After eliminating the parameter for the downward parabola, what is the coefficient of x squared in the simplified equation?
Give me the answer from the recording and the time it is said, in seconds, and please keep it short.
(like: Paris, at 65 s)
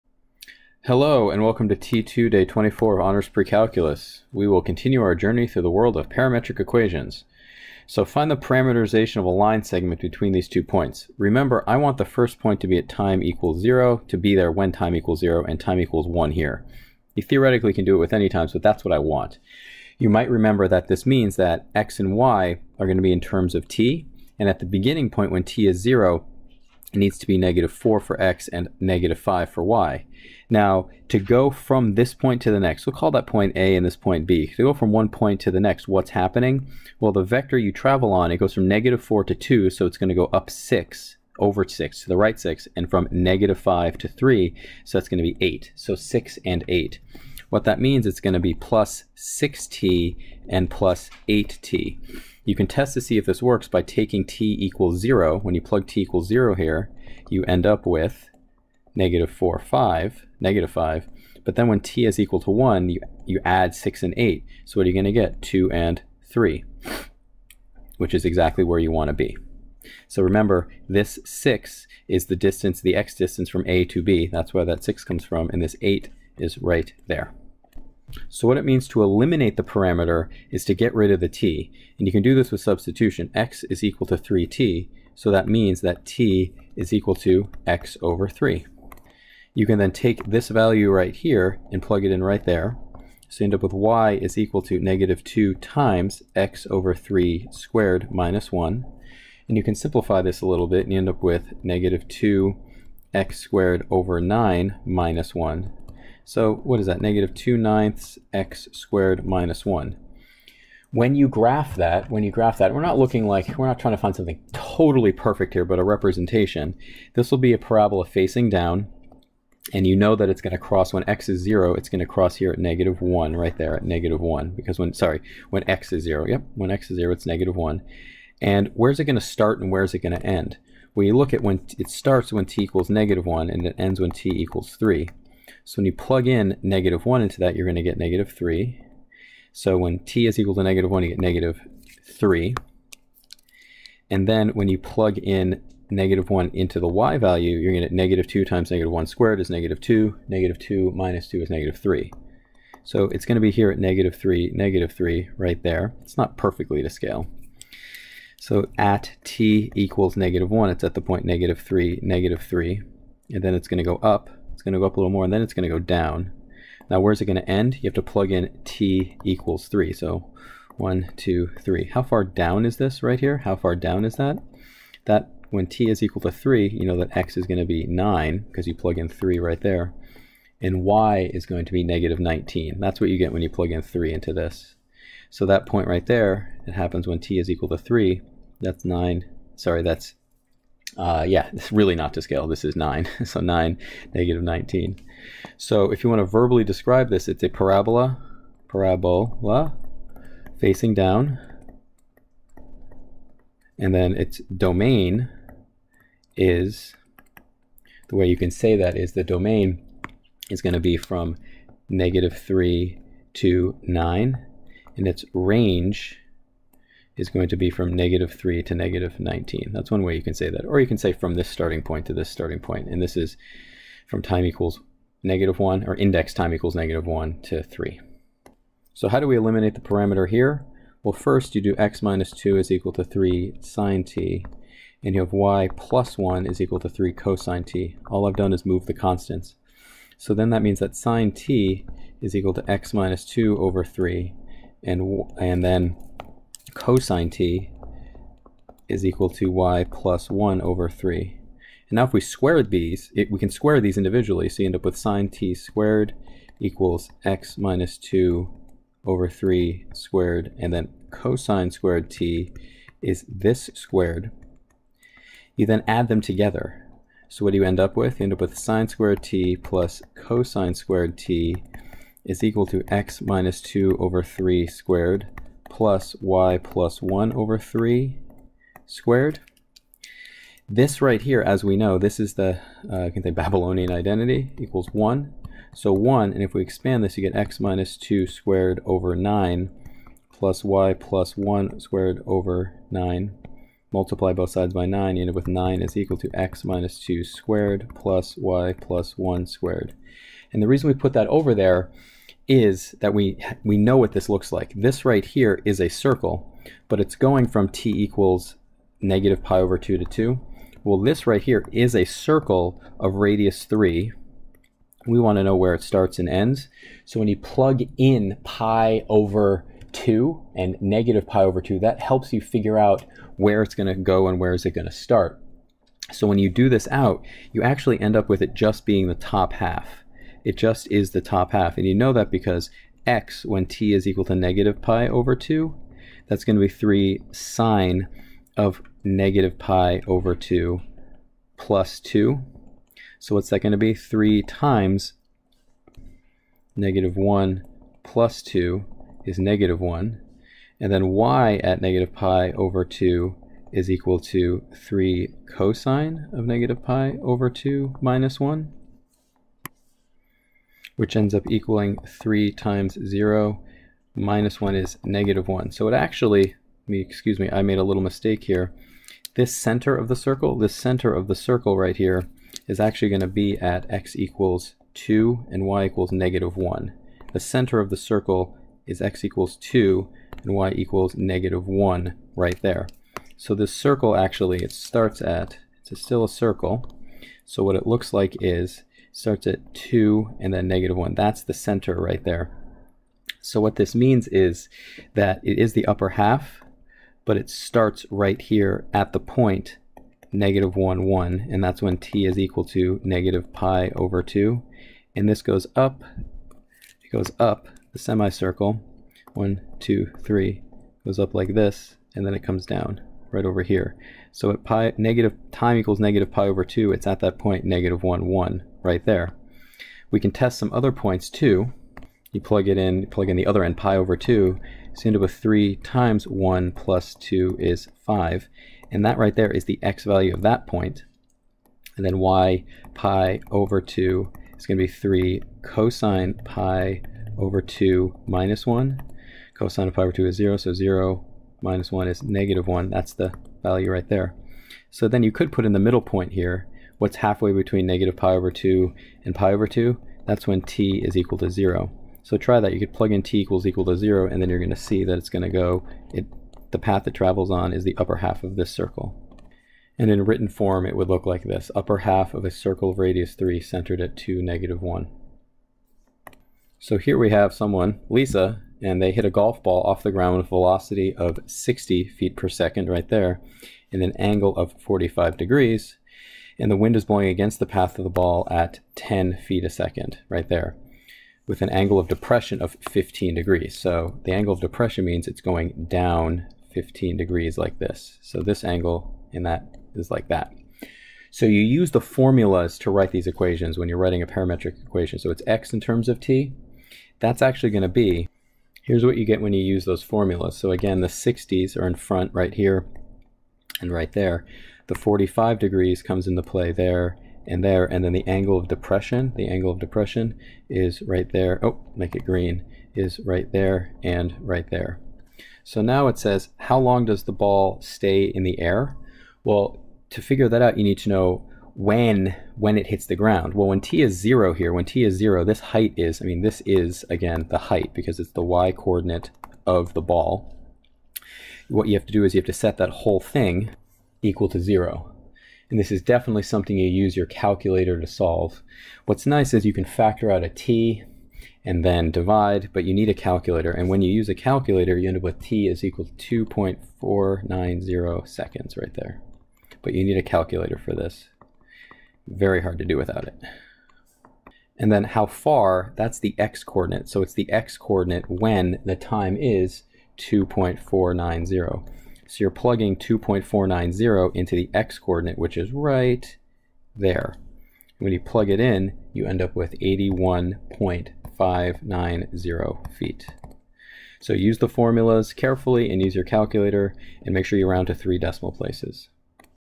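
-2/9, at 107 s.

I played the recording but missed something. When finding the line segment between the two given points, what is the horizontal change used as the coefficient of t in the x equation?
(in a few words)
6.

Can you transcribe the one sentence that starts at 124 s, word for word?
Because when, sorry, when x is 0, yep, when x is 0, it's negative 1.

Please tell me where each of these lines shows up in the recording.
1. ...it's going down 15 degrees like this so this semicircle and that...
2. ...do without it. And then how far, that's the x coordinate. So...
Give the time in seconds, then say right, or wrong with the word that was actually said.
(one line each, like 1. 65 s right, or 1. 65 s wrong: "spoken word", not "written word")
1. 485 s wrong: "angle", not "semicircle"
2. 552 s right.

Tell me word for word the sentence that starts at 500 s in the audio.
So again, the 60s are in front right here and right there.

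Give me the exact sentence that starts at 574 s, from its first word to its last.
So use the formulas carefully and use your calculator and make sure you round to three decimal places.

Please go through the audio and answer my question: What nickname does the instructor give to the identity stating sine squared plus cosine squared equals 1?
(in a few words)
Babylonian identity.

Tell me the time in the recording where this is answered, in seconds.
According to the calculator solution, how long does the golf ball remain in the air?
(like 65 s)
546 s.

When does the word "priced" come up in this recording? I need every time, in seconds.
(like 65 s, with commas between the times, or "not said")
not said.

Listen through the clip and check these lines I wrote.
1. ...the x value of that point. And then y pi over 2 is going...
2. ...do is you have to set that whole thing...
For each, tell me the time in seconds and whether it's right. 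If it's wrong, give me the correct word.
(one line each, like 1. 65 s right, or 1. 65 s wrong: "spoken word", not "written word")
1. 429 s right
2. 532 s right.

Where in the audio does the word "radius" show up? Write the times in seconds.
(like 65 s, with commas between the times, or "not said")
313 s, 462 s.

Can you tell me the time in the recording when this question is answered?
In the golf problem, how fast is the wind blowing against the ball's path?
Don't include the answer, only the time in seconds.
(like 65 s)
478 s.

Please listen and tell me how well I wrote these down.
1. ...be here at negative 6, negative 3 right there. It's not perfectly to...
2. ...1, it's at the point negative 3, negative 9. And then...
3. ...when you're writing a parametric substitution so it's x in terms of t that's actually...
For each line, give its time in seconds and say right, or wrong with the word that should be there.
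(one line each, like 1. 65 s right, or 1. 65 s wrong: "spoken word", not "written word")
1. 153 s wrong: "3", not "6"
2. 160 s wrong: "3", not "9"
3. 493 s wrong: "equation", not "substitution".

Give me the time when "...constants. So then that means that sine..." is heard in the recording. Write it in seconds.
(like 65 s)
238 s.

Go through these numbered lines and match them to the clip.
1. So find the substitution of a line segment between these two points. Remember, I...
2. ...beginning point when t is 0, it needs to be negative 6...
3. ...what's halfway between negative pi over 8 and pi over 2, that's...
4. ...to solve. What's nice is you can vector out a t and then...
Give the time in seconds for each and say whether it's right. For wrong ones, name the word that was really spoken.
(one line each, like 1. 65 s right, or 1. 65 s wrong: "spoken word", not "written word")
1. 7 s wrong: "parameterization", not "substitution"
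2. 24 s wrong: "4", not "6"
3. 446 s wrong: "2", not "8"
4. 537 s wrong: "factor", not "vector".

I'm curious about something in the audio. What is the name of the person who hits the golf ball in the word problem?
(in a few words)
Lisa.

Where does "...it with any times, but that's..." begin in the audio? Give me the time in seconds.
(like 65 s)
17 s.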